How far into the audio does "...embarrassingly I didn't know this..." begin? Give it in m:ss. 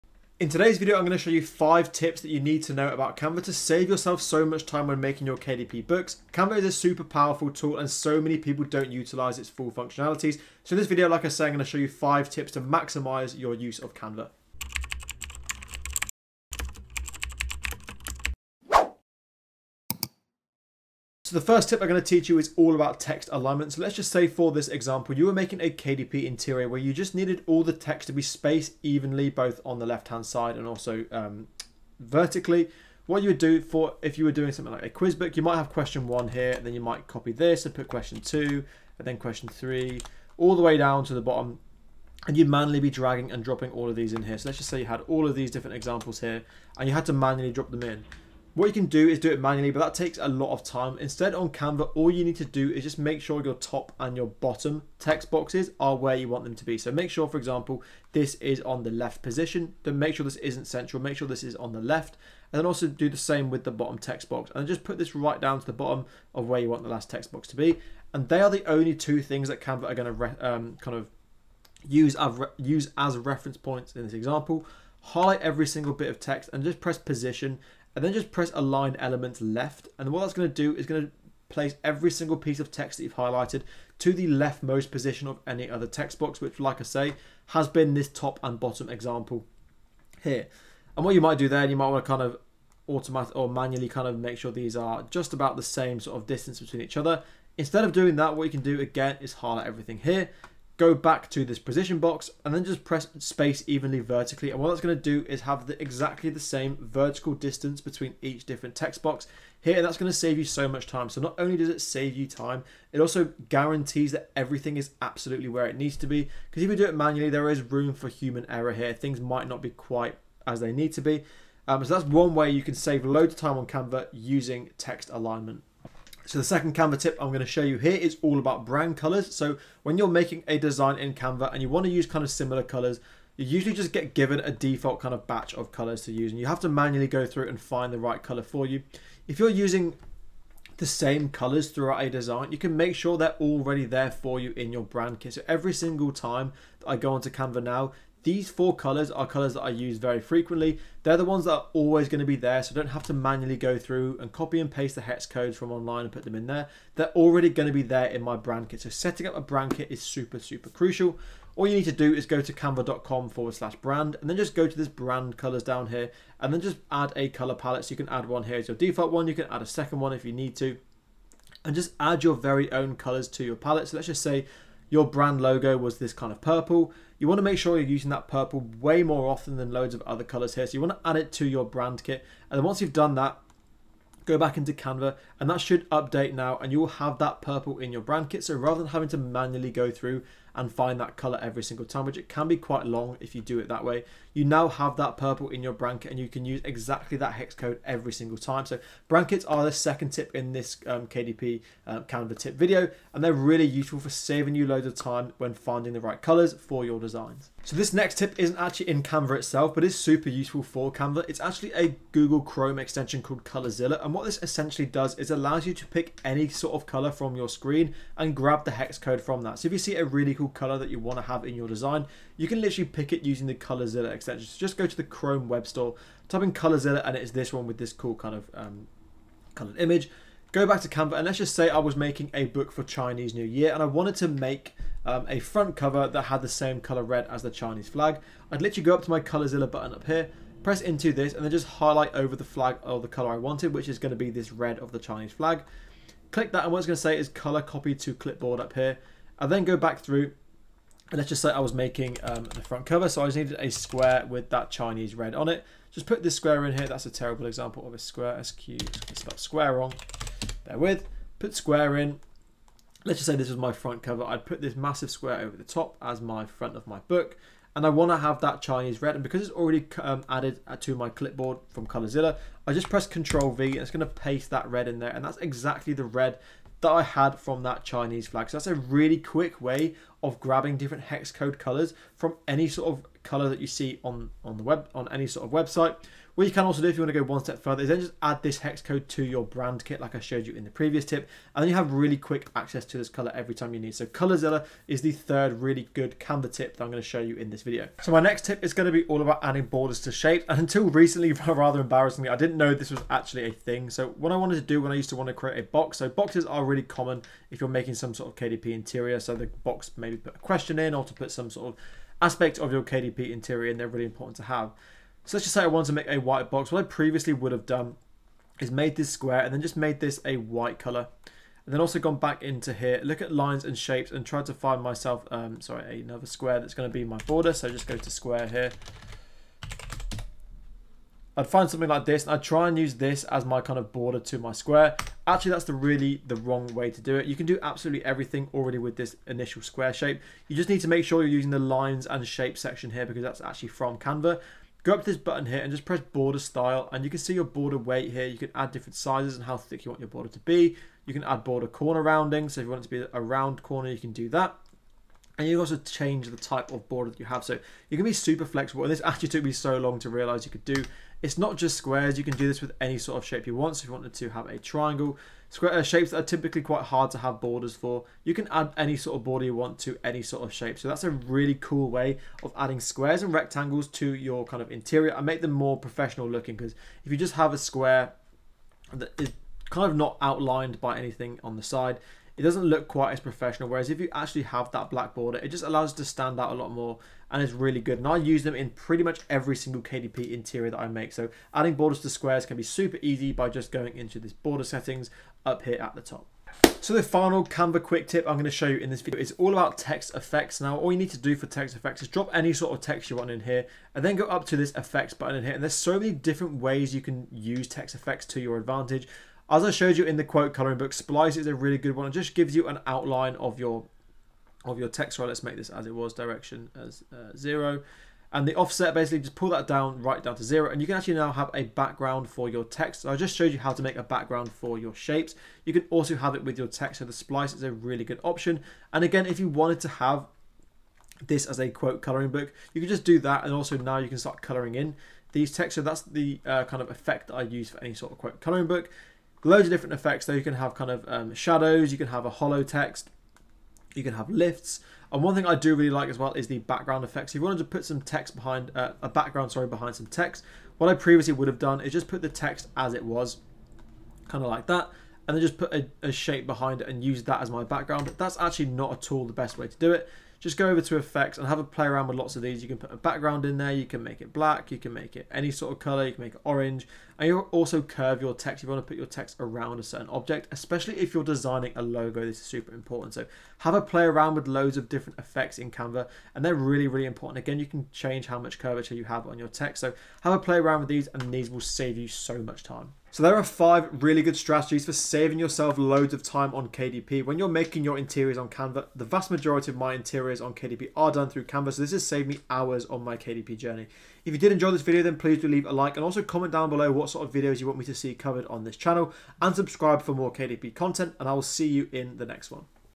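5:01.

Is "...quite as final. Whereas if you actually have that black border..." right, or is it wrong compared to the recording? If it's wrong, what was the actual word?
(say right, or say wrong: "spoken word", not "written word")
wrong: "professional", not "final".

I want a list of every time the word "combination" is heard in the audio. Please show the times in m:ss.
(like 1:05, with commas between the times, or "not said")
not said.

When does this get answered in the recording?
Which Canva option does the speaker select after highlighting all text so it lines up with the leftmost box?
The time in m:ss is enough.
1:18.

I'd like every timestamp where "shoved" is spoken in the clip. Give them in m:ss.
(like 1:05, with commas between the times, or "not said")
not said.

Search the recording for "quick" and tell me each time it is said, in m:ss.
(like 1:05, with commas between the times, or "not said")
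4:39, 4:52, 6:37.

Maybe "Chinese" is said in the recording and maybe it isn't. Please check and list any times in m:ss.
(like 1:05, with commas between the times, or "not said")
3:52, 3:57, 4:04, 4:14, 4:28, 4:37.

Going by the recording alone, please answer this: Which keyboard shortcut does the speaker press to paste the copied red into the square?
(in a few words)
Control V.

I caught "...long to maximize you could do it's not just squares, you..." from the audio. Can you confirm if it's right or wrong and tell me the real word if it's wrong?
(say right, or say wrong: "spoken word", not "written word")
wrong: "realize", not "maximize".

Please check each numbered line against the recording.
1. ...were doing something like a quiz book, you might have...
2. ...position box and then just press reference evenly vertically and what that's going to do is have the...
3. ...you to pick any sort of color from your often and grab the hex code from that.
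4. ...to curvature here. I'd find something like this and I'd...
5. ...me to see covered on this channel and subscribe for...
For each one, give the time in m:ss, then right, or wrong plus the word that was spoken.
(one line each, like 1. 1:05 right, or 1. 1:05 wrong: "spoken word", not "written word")
1. 0:34 right
2. 1:41 wrong: "space", not "reference"
3. 3:35 wrong: "screen", not "often"
4. 5:27 wrong: "square", not "curvature"
5. 8:17 right.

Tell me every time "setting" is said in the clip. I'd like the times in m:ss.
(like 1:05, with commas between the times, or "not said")
2:38, 6:34.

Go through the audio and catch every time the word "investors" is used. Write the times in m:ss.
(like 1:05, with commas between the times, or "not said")
not said.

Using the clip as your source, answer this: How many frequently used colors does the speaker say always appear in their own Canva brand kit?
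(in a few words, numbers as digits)
4.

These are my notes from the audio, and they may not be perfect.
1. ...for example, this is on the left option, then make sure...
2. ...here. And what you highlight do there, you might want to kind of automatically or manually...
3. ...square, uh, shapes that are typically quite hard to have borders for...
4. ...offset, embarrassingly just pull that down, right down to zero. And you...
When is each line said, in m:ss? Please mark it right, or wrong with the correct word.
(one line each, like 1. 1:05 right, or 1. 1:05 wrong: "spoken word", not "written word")
1. 0:57 wrong: "position", not "option"
2. 1:30 wrong: "might", not "highlight"
3. 6:05 right
4. 6:58 wrong: "basically", not "embarrassingly".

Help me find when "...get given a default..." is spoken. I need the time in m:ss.
2:13.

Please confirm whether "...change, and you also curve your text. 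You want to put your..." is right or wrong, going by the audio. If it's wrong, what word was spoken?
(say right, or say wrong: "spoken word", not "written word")
wrong: "orange", not "change".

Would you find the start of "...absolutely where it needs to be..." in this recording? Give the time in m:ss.
1:55.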